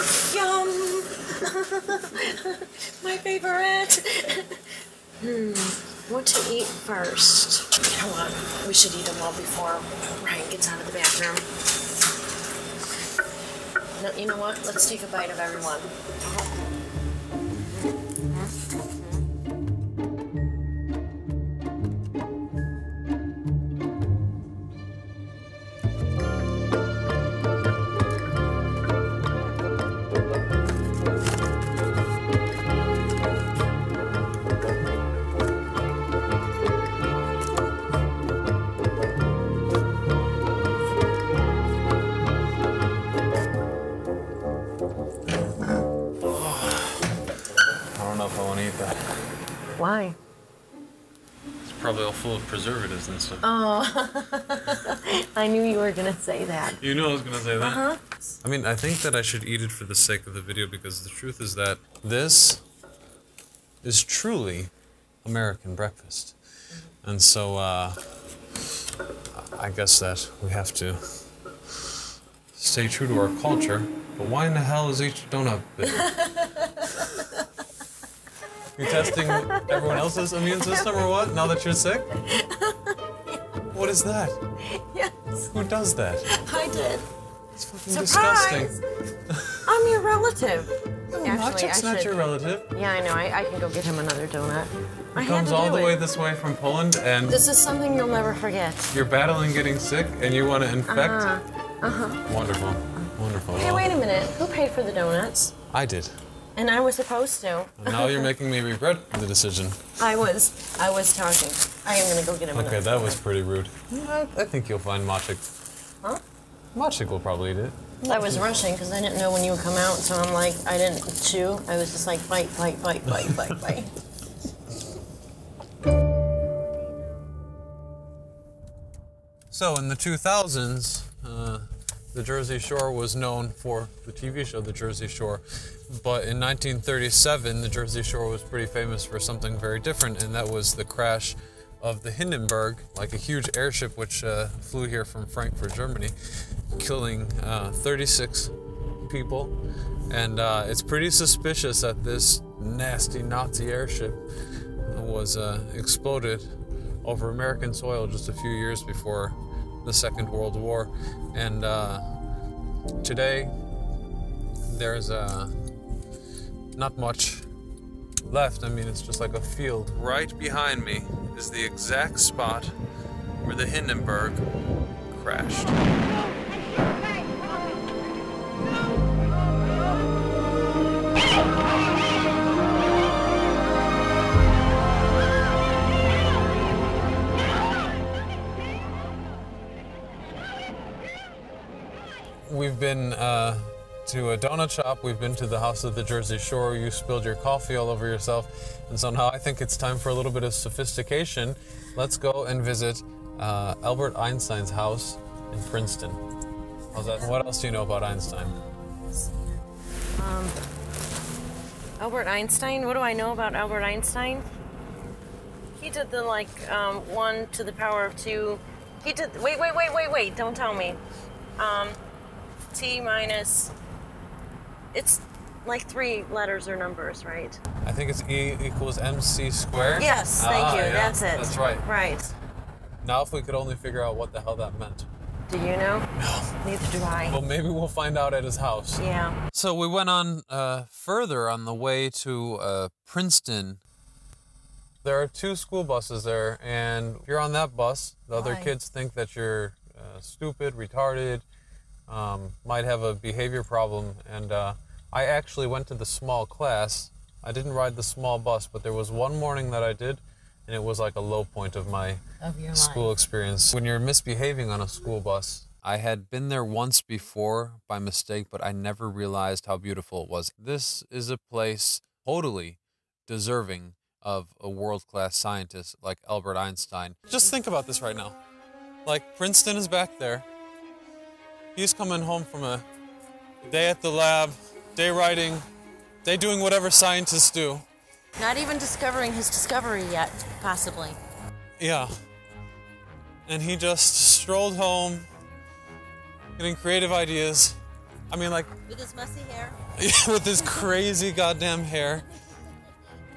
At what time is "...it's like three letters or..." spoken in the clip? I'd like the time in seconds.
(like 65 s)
224 s.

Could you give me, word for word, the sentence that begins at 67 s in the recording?
And so, uh, I guess that we have to stay true to our culture.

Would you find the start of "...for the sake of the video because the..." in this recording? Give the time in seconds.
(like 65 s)
59 s.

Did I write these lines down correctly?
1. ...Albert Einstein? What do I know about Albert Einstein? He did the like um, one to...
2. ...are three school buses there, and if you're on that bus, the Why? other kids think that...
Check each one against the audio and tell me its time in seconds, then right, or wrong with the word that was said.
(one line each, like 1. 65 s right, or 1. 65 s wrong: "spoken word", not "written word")
1. 211 s right
2. 245 s wrong: "two", not "three".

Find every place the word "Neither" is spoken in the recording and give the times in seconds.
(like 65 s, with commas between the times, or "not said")
236 s.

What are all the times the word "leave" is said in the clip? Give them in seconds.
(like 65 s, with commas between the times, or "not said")
not said.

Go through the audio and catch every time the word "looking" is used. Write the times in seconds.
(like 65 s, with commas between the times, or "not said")
not said.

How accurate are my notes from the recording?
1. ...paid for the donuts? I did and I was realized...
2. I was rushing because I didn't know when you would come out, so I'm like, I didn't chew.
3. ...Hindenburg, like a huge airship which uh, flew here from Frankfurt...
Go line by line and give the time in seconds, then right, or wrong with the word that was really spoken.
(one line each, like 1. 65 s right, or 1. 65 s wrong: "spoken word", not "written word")
1. 104 s wrong: "supposed", not "realized"
2. 118 s right
3. 142 s right.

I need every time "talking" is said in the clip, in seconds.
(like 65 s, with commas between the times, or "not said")
111 s.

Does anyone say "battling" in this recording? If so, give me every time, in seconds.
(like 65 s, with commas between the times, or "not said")
99 s.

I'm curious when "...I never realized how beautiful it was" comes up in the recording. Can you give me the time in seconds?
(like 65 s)
268 s.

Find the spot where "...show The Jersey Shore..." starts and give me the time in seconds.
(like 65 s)
134 s.